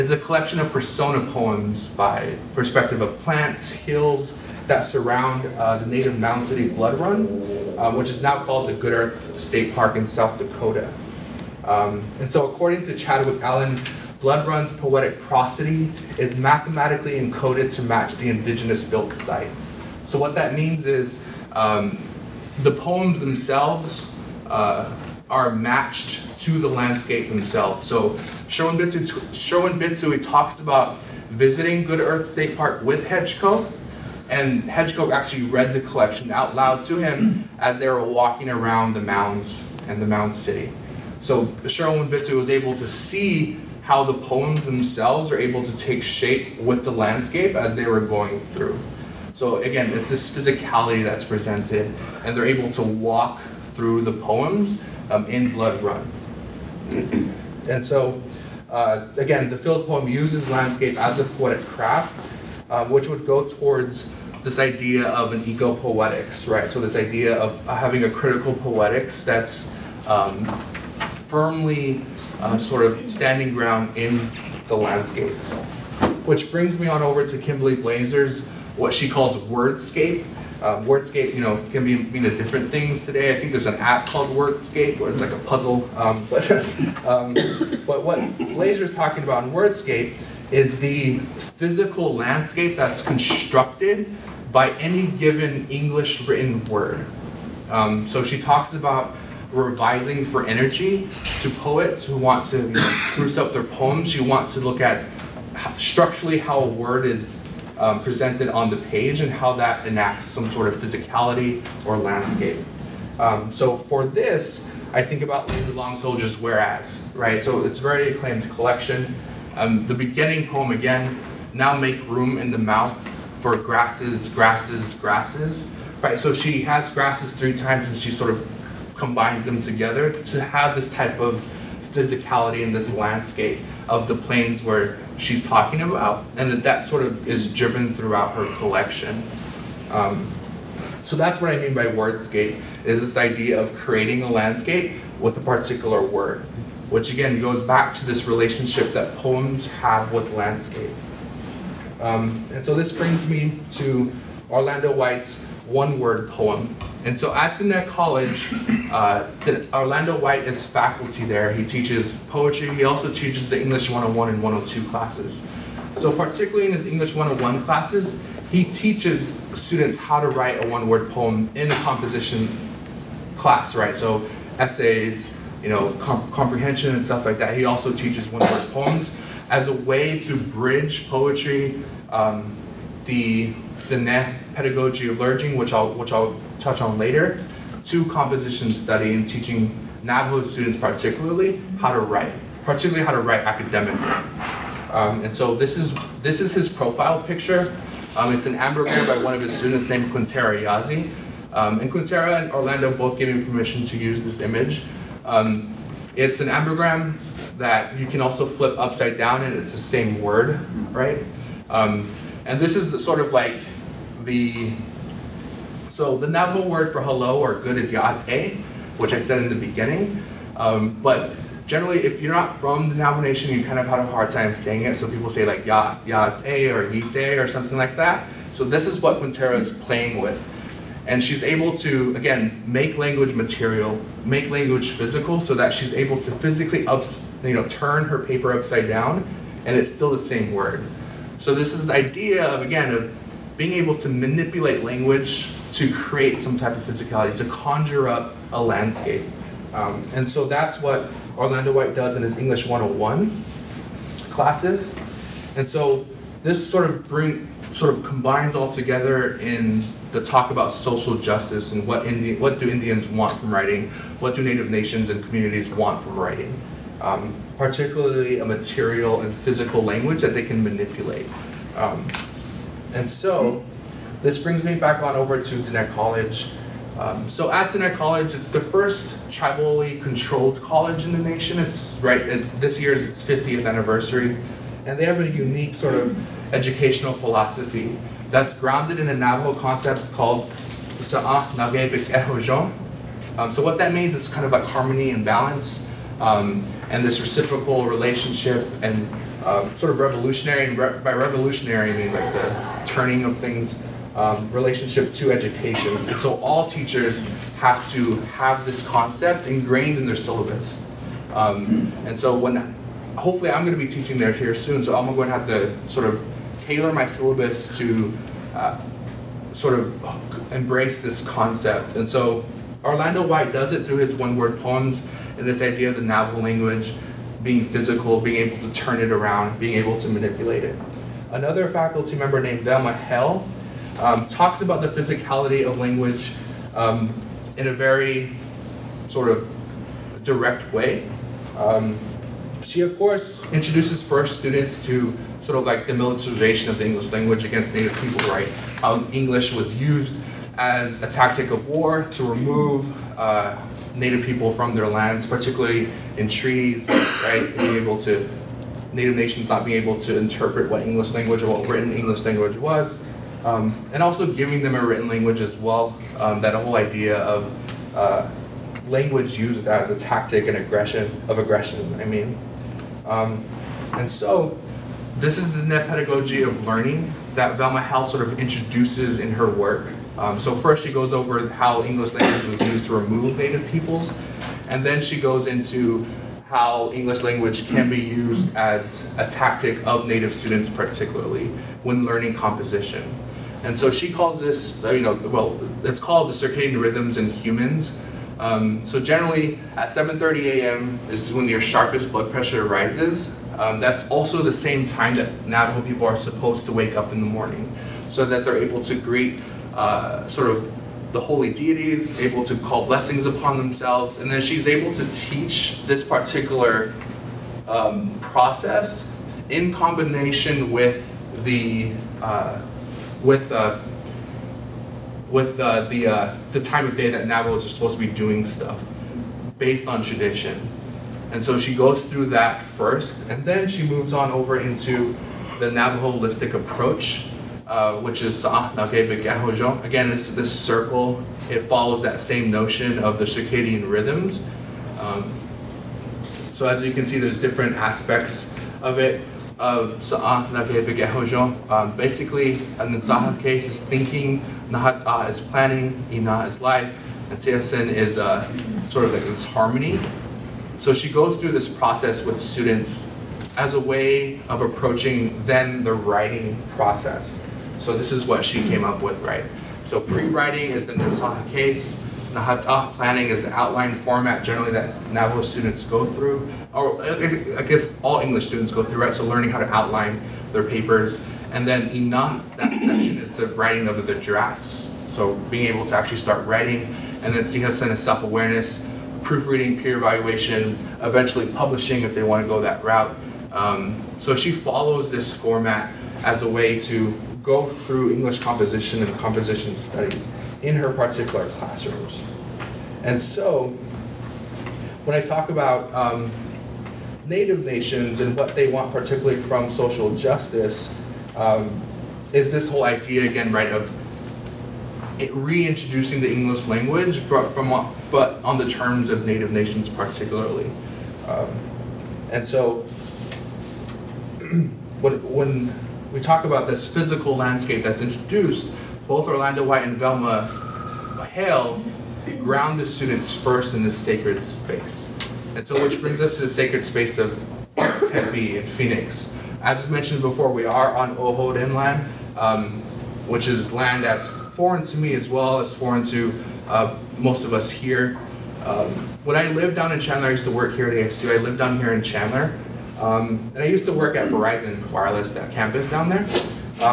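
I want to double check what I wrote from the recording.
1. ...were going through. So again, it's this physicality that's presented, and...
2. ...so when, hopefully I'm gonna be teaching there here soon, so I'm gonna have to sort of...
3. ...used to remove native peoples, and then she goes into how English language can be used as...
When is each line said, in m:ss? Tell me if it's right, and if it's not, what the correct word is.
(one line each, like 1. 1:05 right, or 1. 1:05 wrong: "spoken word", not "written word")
1. 0:47 right
2. 5:12 right
3. 6:22 right.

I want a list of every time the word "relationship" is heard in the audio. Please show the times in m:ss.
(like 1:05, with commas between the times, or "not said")
2:28, 4:57, 5:04.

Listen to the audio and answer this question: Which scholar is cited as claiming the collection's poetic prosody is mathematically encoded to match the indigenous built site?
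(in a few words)
Chadwick Allen.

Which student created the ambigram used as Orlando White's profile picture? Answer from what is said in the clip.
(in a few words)
Quintera Yazzie.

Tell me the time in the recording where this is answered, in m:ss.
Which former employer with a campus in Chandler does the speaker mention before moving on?
9:14.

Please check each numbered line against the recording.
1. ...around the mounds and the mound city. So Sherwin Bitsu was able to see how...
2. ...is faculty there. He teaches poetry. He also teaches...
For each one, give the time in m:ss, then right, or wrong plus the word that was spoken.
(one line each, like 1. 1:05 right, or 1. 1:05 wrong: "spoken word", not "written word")
1. 0:38 right
2. 2:40 right.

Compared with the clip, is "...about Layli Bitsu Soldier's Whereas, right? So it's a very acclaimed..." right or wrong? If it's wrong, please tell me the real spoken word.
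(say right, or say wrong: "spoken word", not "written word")
wrong: "Long", not "Bitsu".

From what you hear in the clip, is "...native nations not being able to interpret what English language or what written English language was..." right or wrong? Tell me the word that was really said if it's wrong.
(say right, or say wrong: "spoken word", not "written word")
right.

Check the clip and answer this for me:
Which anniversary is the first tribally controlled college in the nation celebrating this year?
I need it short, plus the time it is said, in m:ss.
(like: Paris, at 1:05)
50th, at 4:43.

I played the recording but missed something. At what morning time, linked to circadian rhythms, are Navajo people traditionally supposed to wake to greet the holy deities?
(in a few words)
7:30 a.m.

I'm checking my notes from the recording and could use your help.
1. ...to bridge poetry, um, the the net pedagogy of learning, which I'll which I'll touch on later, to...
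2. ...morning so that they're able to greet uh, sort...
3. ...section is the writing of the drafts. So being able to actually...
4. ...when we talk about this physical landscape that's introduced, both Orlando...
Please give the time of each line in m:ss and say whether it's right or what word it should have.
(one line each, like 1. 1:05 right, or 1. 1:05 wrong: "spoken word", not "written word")
1. 3:00 right
2. 6:47 right
3. 8:02 right
4. 8:45 right.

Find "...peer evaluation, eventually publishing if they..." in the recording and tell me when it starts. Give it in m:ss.
8:09.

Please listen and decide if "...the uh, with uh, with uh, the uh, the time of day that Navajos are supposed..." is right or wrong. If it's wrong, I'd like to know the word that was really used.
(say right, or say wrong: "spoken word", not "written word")
right.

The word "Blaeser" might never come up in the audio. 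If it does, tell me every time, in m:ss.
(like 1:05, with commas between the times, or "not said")
1:17, 1:28.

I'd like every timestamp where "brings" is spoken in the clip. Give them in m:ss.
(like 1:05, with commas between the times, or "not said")
1:16, 2:32, 4:17, 4:34, 8:55.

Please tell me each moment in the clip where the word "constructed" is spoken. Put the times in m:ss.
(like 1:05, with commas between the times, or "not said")
1:33.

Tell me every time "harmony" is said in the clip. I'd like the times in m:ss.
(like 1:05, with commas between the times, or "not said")
4:54, 7:39.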